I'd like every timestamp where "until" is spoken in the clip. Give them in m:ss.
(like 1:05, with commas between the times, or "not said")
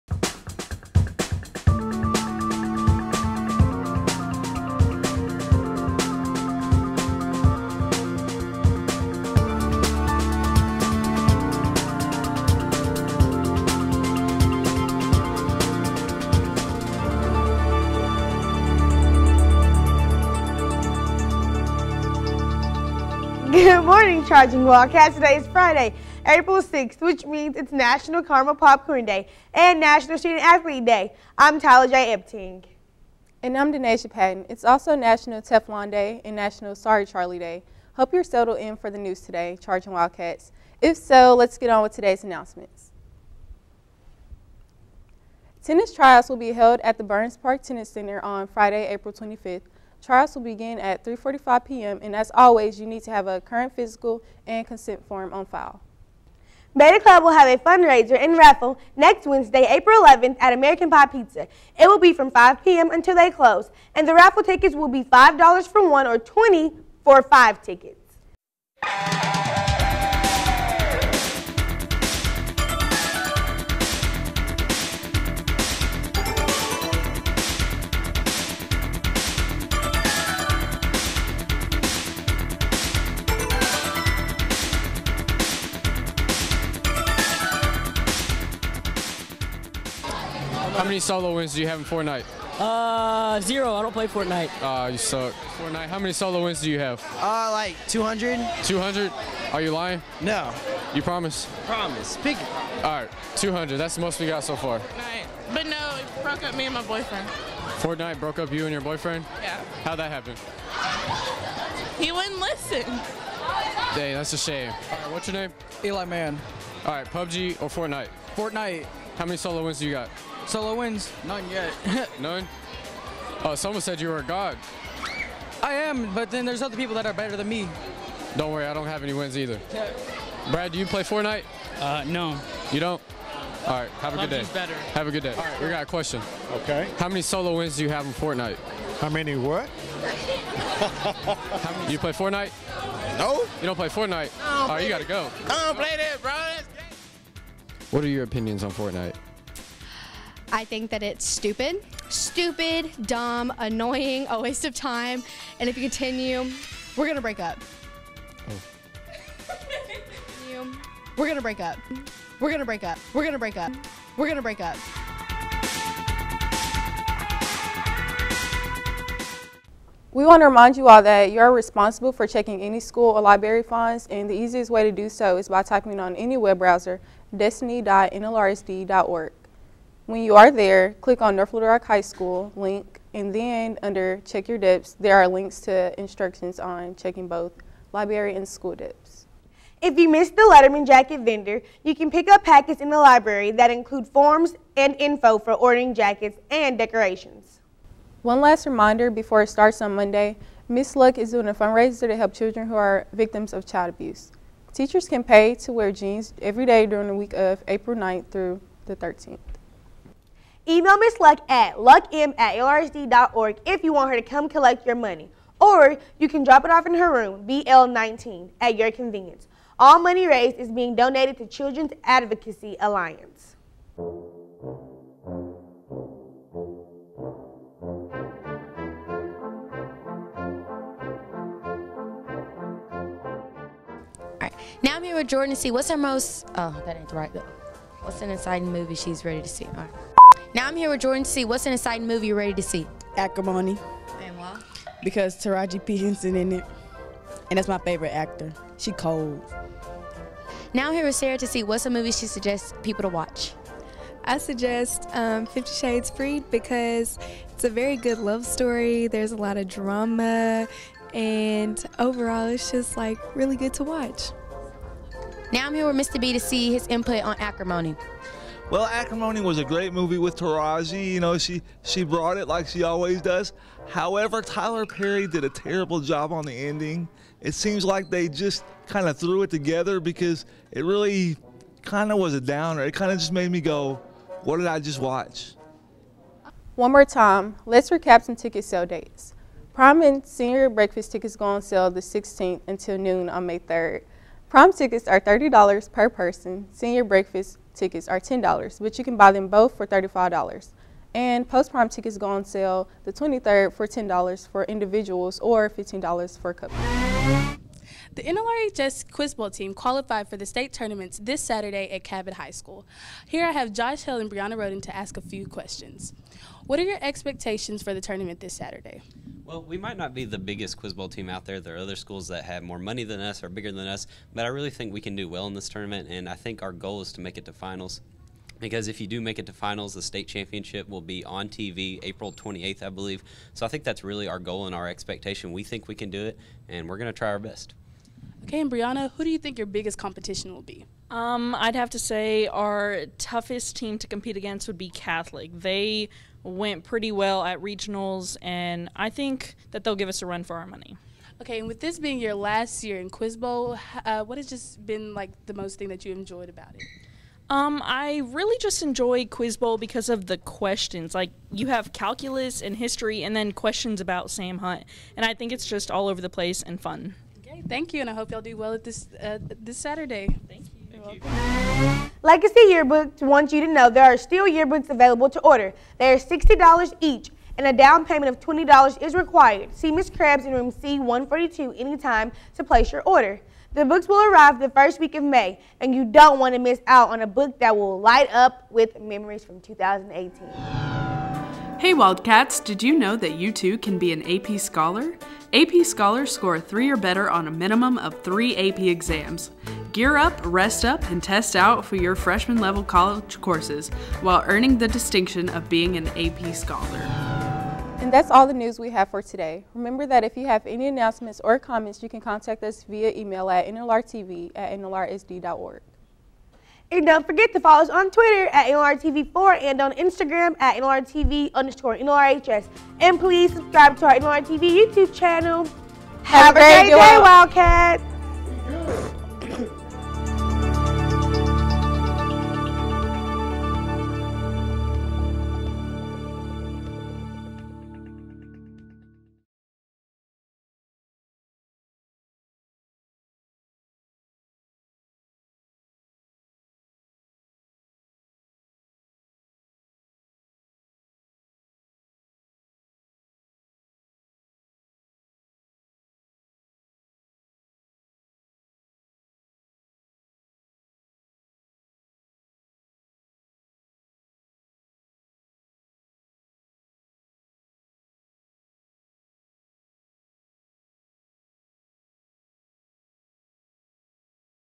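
1:02, 4:52.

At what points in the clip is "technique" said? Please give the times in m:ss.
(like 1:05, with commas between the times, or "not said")
not said.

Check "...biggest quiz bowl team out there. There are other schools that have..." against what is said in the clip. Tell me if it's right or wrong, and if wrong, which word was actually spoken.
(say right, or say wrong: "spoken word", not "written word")
right.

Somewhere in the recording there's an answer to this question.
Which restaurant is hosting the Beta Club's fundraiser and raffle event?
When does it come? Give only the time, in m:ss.
1:00.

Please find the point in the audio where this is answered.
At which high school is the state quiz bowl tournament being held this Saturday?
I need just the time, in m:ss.
5:12.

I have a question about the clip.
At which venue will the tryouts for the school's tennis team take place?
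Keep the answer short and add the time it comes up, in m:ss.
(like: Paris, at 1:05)
Burns Park Tennis Center, at 0:47.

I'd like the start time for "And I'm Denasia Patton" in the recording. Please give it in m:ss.
0:33.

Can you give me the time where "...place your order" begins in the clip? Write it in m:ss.
6:22.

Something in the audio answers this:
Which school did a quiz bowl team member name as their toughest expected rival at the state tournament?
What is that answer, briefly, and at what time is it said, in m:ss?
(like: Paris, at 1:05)
Catholic, at 5:44.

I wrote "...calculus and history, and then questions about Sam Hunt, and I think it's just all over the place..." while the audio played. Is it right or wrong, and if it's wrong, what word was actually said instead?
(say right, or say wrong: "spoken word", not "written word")
right.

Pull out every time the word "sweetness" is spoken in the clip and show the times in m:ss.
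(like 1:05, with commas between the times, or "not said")
not said.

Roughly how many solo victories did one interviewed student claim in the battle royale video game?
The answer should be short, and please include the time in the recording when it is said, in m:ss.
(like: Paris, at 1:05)
200, at 1:37.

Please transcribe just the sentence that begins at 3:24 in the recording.
Teachers can pay to wear jeans every day during the week of April 9th through the 13th.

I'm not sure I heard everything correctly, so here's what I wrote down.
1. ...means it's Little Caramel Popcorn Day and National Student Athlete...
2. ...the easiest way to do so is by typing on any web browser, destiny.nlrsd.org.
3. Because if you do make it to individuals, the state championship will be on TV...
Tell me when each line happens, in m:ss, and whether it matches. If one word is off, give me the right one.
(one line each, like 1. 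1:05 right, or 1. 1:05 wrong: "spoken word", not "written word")
1. 0:27 wrong: "National", not "Little"
2. 2:54 right
3. 5:28 wrong: "finals", not "individuals".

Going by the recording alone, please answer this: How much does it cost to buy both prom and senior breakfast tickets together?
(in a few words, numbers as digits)
$35.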